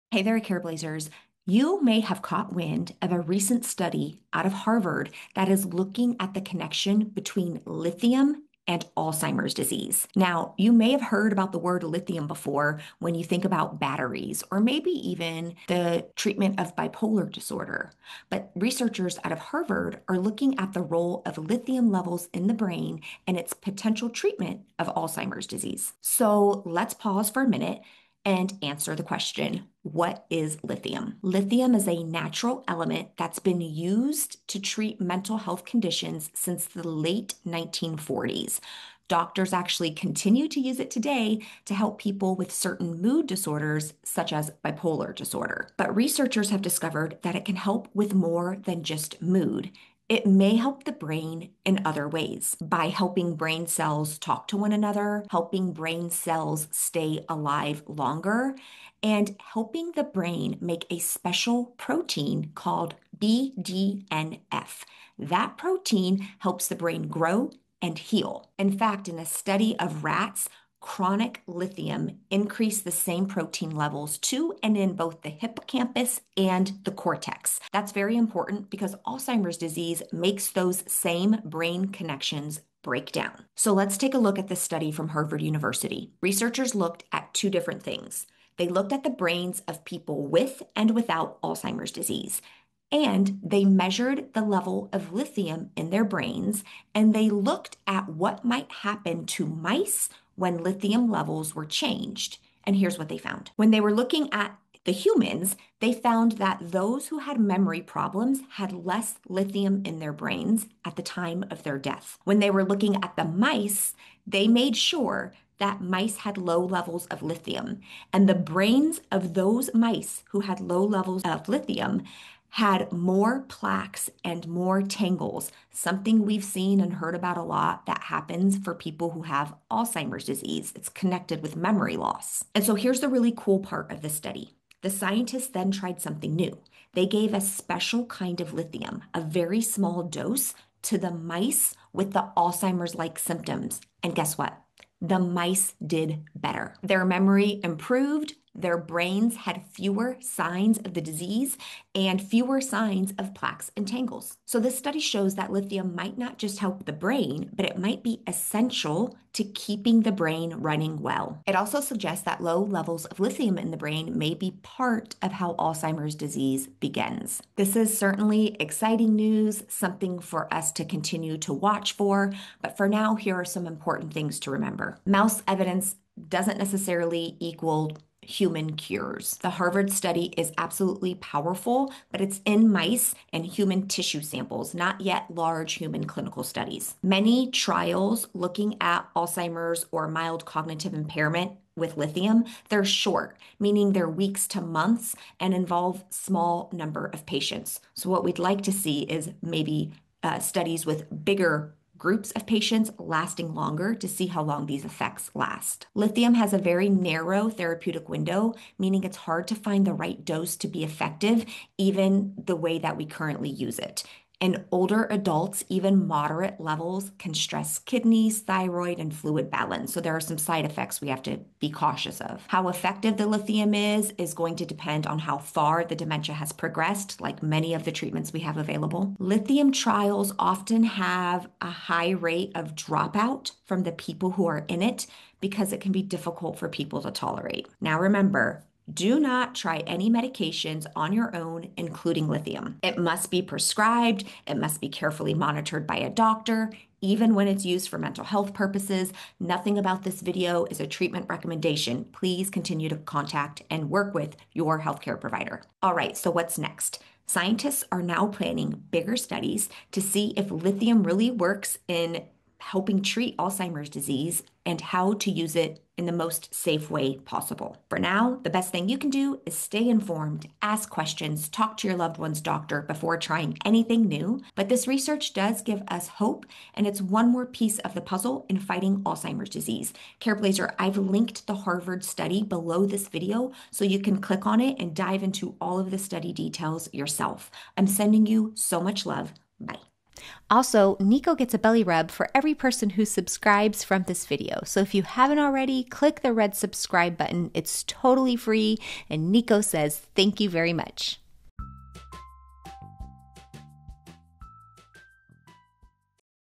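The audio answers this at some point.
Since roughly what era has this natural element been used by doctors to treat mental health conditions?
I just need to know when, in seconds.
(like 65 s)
36 s.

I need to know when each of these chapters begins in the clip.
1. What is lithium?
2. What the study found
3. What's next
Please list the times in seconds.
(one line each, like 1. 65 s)
1. 30 s
2. 85 s
3. 260 s.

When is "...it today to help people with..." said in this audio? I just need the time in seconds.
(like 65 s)
40 s.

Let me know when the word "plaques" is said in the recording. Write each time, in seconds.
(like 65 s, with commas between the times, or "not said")
123 s, 153 s.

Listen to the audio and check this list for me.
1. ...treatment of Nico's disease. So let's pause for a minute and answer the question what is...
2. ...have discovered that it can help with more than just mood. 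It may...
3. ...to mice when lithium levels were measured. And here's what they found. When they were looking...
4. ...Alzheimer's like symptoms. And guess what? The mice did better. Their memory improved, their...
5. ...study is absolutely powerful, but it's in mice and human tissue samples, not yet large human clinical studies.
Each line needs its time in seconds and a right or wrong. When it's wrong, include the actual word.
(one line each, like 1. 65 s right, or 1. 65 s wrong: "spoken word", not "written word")
1. 24 s wrong: "Alzheimer", not "Nico"
2. 46 s right
3. 99 s wrong: "changed", not "measured"
4. 142 s right
5. 179 s right.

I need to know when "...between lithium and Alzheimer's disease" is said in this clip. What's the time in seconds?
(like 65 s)
7 s.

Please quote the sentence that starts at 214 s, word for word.
In older adults, even moderate levels can stress kidneys, thyroid, and fluid balance.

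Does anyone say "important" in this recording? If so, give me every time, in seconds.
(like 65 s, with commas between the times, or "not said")
78 s, 173 s.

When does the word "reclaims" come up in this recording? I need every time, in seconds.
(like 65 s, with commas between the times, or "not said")
not said.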